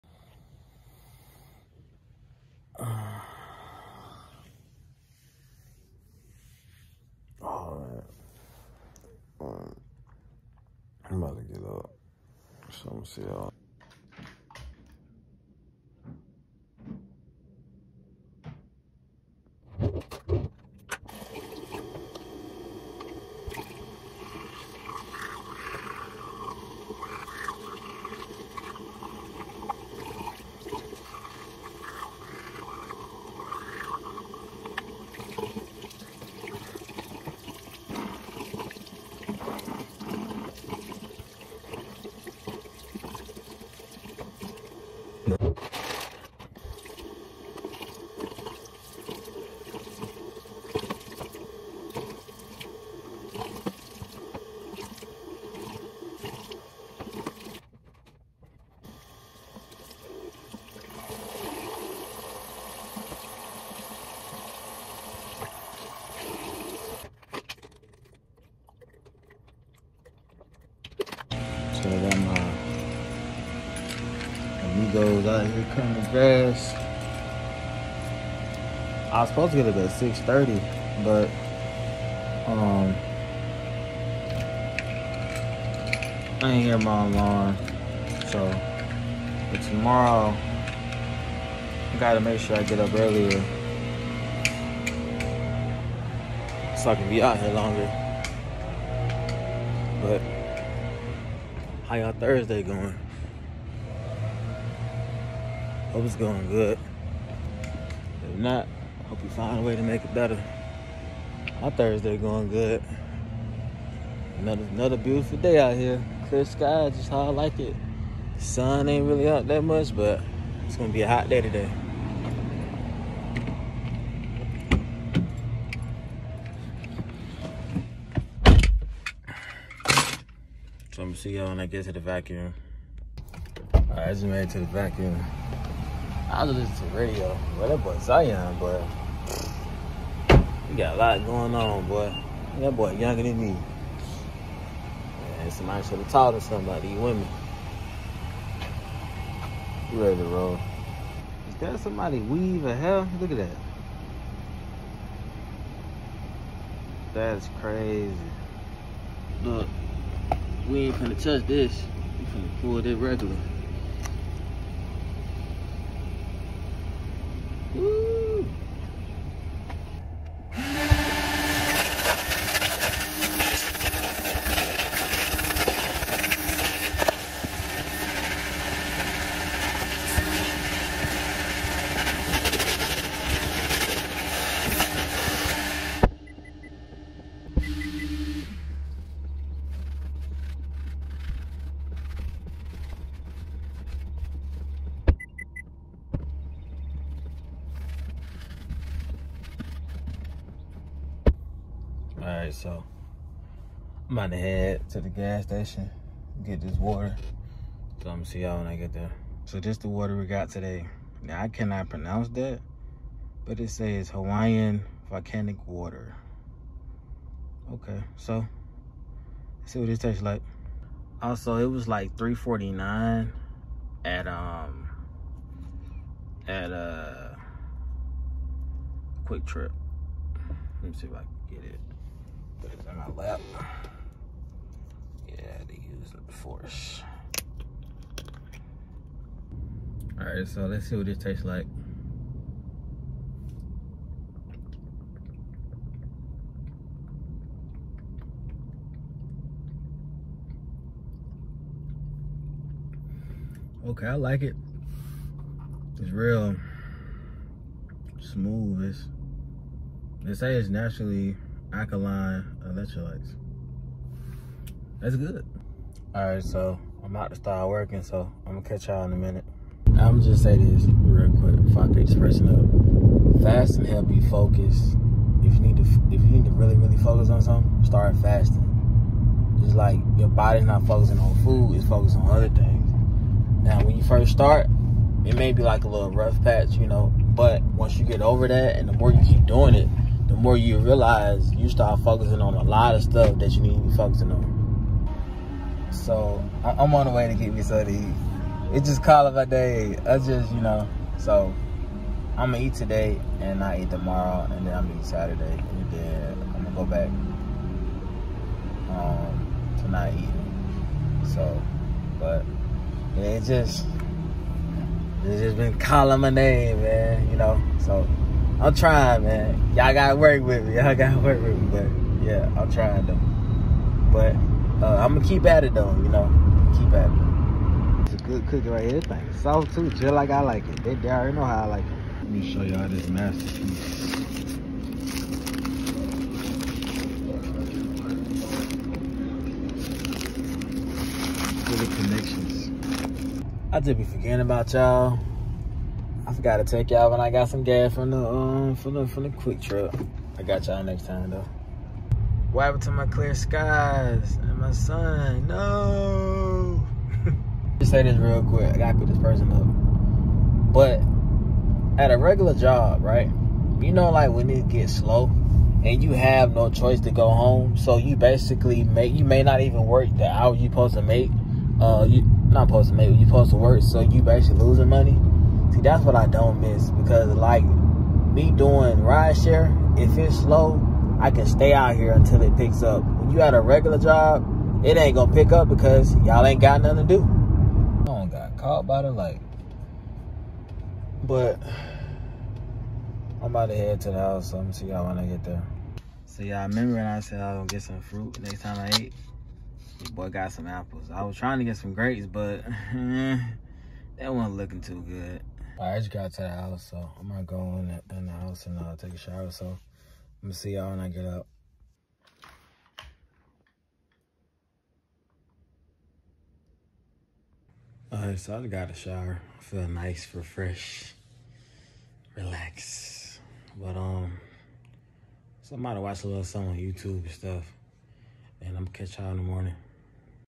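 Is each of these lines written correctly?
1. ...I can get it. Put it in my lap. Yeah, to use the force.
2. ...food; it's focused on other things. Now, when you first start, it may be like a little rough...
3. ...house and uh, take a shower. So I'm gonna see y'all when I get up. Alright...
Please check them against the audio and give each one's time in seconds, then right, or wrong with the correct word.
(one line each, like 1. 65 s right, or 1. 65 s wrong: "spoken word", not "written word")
1. 231 s right
2. 281 s right
3. 408 s right.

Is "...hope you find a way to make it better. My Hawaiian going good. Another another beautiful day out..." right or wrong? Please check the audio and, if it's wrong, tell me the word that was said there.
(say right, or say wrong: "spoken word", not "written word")
wrong: "Thursday", not "Hawaiian".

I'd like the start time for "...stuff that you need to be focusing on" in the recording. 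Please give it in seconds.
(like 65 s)
293 s.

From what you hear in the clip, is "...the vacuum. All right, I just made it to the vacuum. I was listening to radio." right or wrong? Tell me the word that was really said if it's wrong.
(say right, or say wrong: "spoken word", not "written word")
right.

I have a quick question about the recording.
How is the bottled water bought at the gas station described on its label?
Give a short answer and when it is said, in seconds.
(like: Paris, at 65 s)
Hawaiian volcanic water, at 214 s.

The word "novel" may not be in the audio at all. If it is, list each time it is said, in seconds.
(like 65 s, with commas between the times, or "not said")
not said.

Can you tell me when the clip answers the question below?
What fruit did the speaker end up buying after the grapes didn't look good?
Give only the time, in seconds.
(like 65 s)
400 s.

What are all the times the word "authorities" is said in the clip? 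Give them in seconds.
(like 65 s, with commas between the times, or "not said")
not said.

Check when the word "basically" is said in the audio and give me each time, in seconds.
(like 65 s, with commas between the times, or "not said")
368 s, 374 s.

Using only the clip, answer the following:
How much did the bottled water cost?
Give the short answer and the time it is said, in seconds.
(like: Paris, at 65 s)
3.49, at 222 s.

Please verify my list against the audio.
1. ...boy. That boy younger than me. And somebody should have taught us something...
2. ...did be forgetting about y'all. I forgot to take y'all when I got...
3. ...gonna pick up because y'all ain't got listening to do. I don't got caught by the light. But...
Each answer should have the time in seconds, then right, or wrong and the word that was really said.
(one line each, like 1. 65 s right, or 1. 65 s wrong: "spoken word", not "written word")
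1. 141 s right
2. 343 s right
3. 385 s wrong: "nothing", not "listening".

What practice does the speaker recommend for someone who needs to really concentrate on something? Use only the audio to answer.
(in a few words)
fasting.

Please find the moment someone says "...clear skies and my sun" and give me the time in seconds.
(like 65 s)
353 s.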